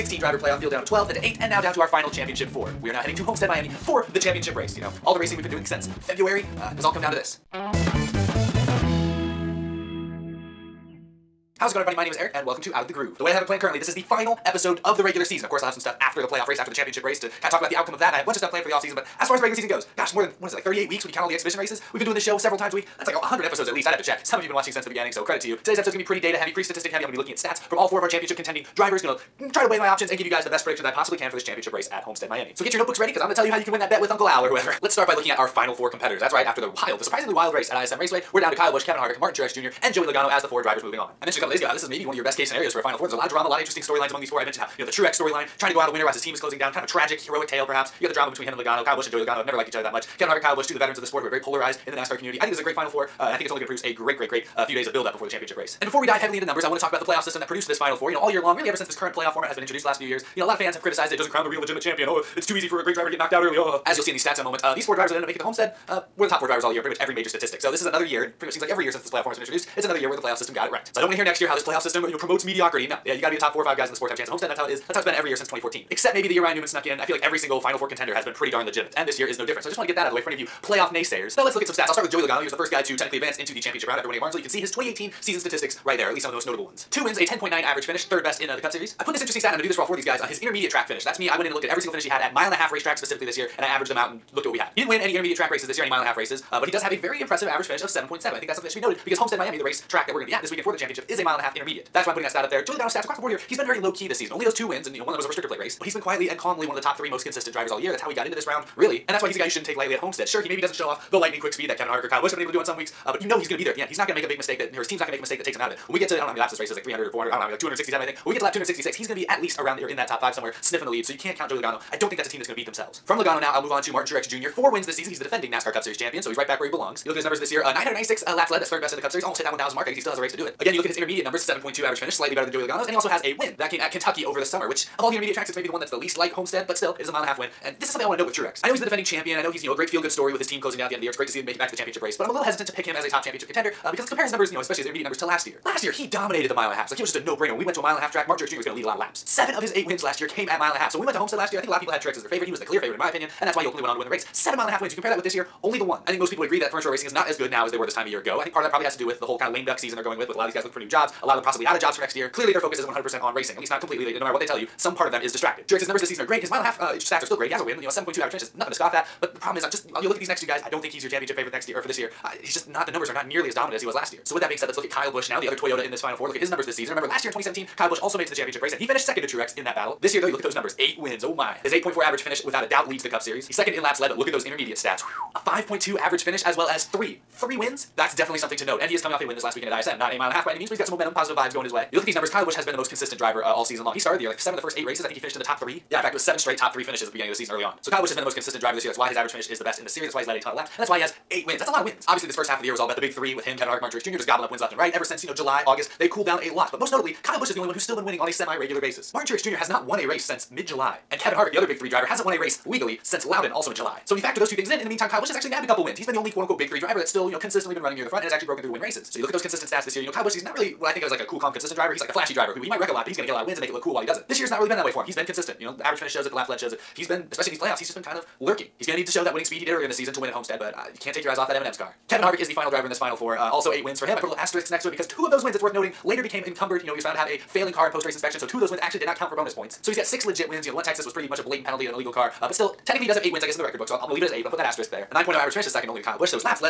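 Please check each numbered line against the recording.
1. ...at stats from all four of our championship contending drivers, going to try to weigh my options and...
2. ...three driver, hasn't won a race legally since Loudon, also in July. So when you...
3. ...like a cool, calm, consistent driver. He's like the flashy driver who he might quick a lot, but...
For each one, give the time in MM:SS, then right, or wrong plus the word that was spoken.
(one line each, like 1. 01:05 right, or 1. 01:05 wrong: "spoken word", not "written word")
1. 00:27 right
2. 03:31 right
3. 03:41 wrong: "wreck", not "quick".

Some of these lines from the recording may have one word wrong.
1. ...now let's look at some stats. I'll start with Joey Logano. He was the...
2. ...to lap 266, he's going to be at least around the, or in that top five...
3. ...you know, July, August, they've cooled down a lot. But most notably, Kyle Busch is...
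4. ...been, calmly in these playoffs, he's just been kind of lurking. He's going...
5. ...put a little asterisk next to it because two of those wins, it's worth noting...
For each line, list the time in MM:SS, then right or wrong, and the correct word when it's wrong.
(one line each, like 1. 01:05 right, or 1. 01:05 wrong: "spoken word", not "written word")
1. 01:21 right
2. 01:58 right
3. 03:25 right
4. 03:47 wrong: "especially", not "calmly"
5. 03:54 right.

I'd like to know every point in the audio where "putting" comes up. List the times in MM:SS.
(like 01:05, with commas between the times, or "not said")
01:42, 04:04.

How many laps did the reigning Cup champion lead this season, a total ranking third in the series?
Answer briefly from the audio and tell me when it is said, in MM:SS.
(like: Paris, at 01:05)
996, at 02:07.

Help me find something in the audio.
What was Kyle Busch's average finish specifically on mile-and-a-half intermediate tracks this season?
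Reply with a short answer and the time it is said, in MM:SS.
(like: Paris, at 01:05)
5.2, at 03:05.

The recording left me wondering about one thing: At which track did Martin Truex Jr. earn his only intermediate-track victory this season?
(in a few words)
Kentucky.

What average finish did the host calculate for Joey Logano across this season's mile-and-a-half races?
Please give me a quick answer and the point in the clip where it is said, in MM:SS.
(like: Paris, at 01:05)
7.7, at 01:37.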